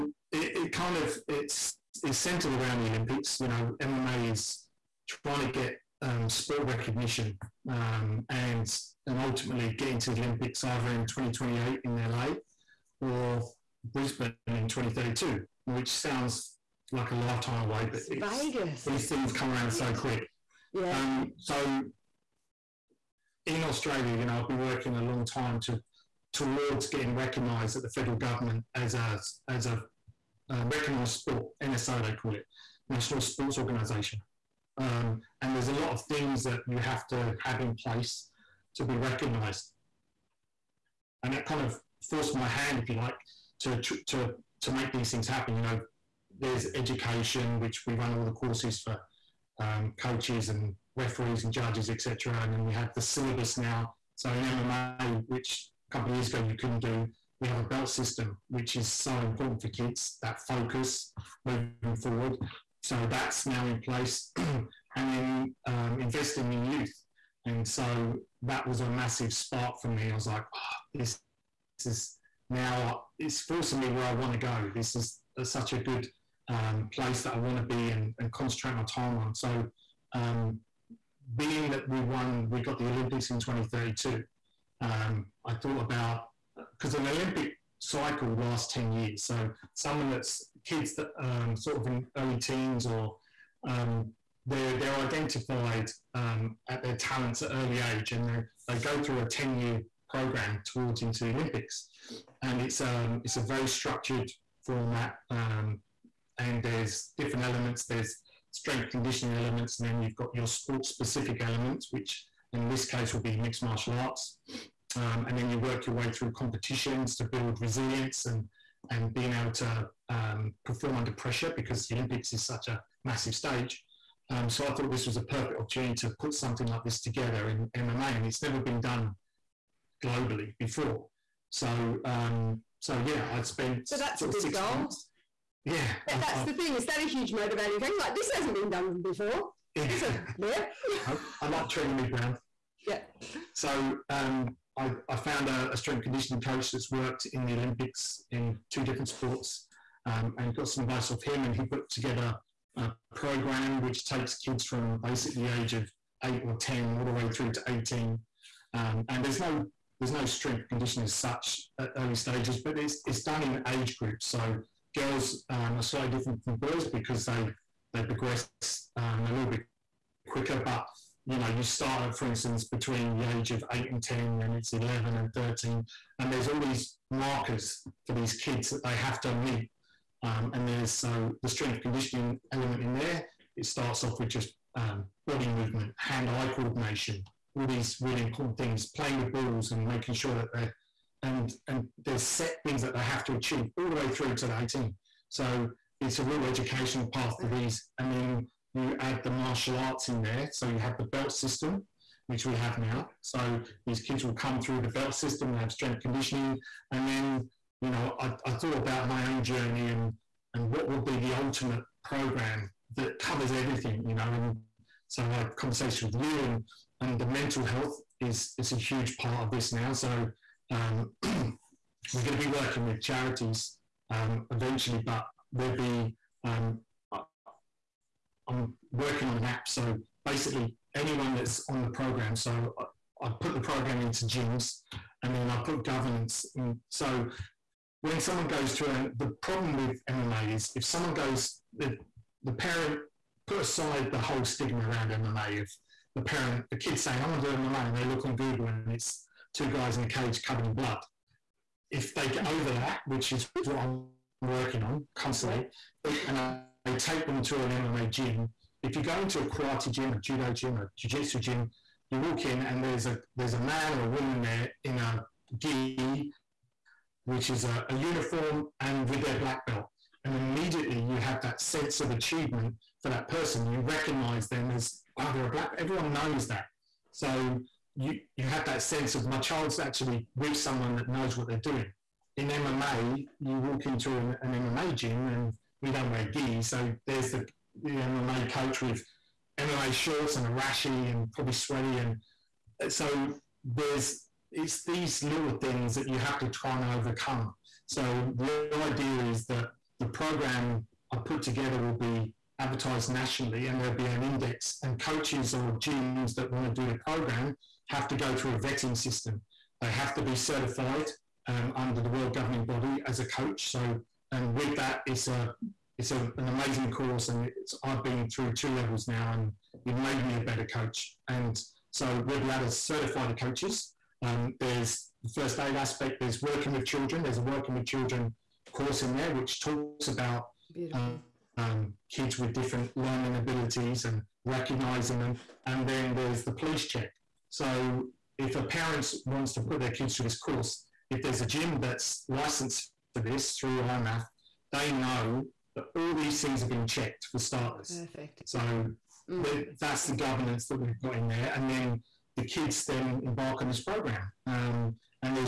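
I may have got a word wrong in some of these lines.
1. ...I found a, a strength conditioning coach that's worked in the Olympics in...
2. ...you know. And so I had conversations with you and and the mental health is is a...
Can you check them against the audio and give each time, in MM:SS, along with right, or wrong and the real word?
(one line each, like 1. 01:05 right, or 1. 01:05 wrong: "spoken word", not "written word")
1. 02:25 right
2. 03:34 right.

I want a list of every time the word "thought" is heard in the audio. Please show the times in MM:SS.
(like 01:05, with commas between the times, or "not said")
01:25, 02:04, 03:28.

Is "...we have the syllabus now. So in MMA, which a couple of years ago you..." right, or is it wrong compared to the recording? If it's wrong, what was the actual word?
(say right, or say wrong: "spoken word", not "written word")
right.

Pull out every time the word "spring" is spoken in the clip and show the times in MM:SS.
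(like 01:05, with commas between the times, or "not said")
not said.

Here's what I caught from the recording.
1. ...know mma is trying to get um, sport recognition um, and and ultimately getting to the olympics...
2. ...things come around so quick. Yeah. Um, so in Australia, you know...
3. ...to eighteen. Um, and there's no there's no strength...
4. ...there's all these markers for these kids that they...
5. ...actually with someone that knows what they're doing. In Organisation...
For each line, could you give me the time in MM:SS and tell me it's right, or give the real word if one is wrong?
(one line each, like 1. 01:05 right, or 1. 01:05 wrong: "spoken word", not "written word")
1. 00:03 right
2. 00:19 right
3. 02:37 right
4. 02:56 right
5. 04:39 wrong: "MMA", not "Organisation".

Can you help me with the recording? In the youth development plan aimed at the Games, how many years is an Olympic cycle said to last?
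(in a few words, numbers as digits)
10 years.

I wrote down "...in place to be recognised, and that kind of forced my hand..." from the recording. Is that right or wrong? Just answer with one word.
right.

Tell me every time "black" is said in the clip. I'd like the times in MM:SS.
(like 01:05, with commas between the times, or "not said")
04:29, 04:35.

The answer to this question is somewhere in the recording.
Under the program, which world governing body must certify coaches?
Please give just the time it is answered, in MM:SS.
05:43.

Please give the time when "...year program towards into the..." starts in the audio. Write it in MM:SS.
01:39.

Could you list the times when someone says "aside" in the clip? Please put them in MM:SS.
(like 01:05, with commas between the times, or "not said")
04:03.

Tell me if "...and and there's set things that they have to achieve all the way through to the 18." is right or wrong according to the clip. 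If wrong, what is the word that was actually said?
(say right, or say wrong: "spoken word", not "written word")
right.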